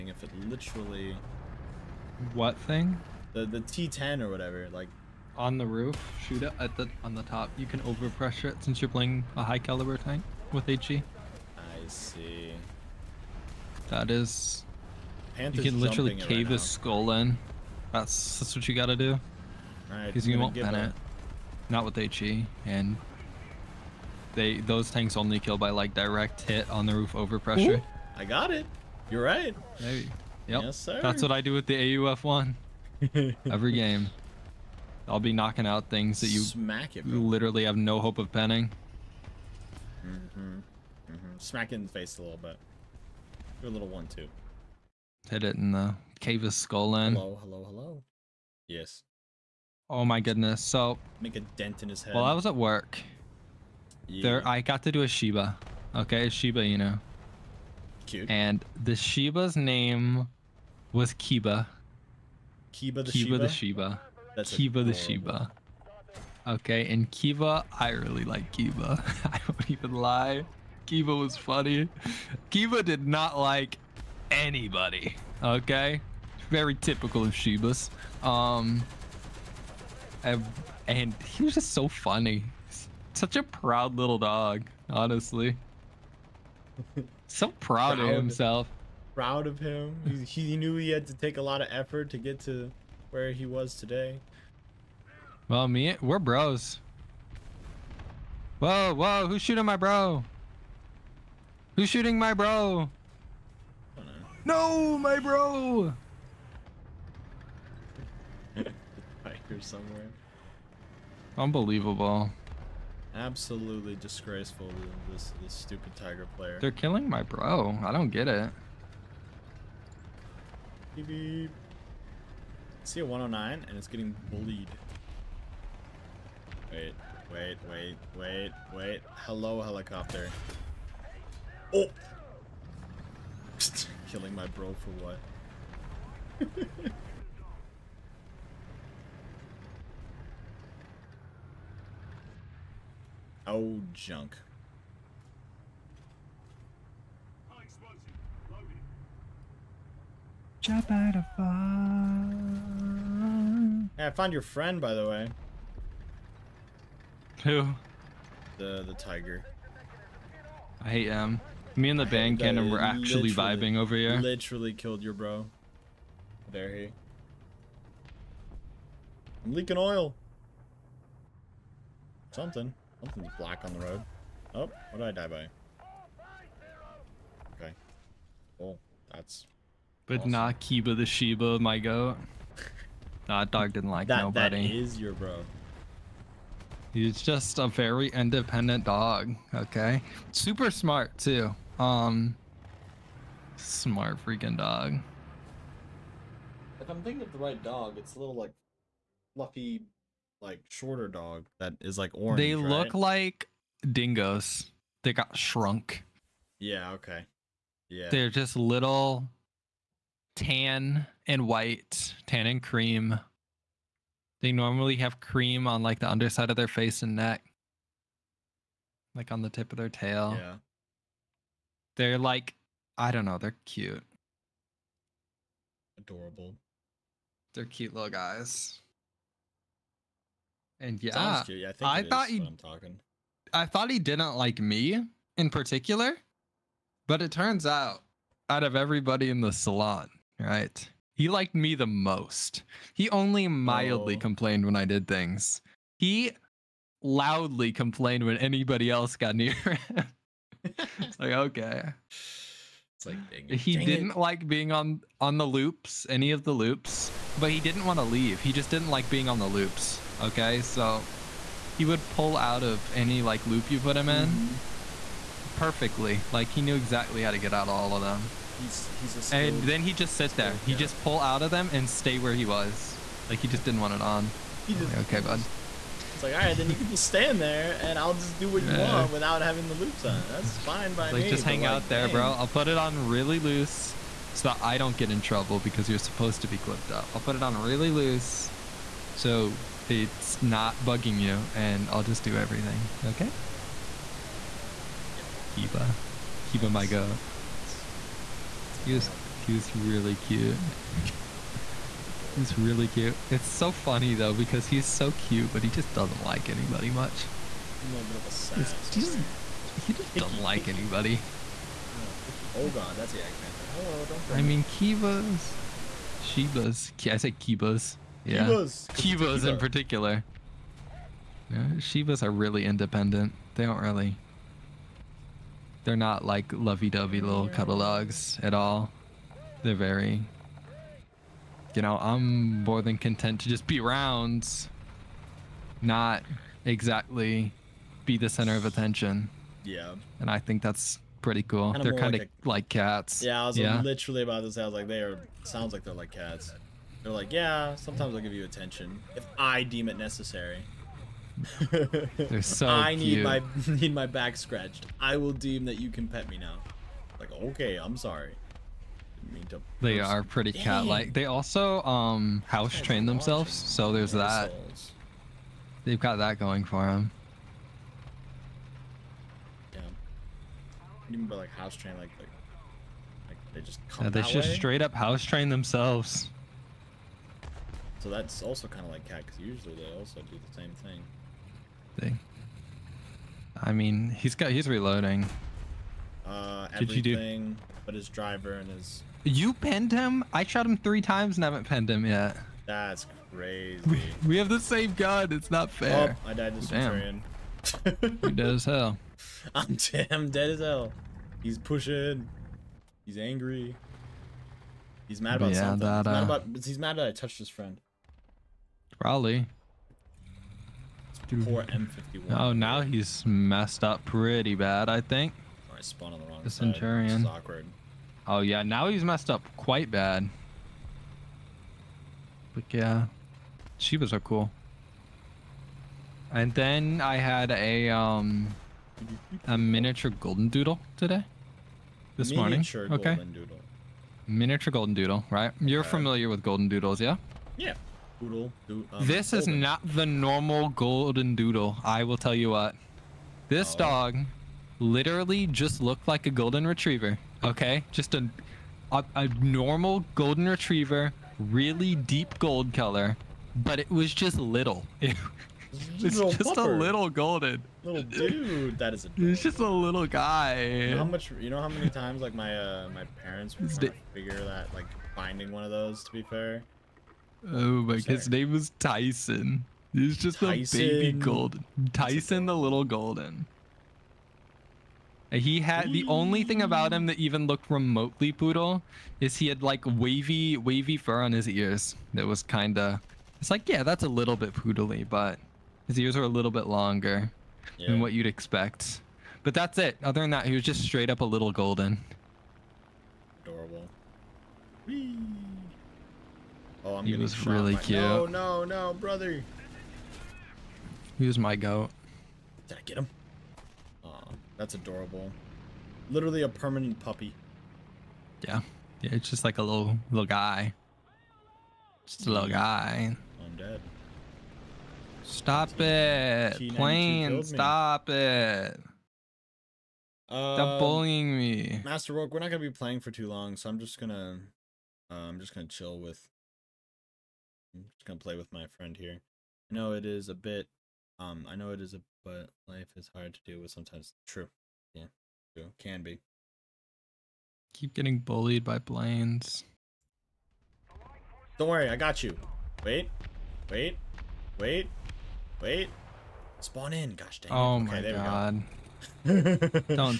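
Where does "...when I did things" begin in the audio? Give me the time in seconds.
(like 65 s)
244 s.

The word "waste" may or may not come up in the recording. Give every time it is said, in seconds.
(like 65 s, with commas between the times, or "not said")
not said.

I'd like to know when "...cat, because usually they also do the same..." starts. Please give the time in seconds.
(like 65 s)
379 s.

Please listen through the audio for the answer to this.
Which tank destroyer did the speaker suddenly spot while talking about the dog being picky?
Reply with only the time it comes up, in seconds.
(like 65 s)
313 s.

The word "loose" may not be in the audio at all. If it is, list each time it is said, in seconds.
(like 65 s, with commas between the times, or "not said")
283 s, 287 s.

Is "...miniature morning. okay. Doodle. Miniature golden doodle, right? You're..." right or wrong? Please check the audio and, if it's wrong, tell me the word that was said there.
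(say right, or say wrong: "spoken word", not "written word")
right.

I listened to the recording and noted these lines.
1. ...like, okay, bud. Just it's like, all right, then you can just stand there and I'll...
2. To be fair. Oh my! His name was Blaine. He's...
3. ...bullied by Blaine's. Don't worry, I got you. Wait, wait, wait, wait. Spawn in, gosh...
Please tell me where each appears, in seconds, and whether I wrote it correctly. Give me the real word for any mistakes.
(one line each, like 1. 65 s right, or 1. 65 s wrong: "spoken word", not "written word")
1. 274 s right
2. 466 s wrong: "Tyson", not "Blaine"
3. 538 s right.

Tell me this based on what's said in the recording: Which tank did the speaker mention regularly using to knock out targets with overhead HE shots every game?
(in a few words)
AUF one.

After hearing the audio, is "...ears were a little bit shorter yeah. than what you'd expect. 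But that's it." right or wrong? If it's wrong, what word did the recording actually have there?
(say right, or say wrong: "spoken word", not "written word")
wrong: "longer", not "shorter".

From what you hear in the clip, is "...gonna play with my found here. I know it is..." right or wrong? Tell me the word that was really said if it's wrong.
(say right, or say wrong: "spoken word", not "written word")
wrong: "friend", not "found".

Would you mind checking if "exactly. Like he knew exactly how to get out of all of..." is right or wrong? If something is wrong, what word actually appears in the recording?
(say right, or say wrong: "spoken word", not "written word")
wrong: "perfectly", not "exactly".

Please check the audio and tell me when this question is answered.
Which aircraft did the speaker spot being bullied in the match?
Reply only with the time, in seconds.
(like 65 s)
123 s.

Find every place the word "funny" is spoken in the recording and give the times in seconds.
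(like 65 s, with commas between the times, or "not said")
71 s, 81 s, 303 s.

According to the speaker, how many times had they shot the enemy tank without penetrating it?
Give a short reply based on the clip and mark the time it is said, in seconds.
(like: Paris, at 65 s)
3, at 390 s.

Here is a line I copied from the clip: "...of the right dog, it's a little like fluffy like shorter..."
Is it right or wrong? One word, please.
right.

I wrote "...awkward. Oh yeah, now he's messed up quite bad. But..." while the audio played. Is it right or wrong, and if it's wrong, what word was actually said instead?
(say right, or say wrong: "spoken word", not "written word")
right.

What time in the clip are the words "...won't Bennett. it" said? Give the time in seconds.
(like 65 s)
20 s.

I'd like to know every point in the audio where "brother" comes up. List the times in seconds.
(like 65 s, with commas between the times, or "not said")
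498 s.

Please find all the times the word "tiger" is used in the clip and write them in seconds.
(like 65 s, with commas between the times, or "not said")
115 s, 158 s.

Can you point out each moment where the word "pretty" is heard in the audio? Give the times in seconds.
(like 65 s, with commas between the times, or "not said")
341 s, 360 s, 414 s.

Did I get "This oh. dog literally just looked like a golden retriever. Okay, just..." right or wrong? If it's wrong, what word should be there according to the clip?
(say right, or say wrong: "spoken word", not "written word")
right.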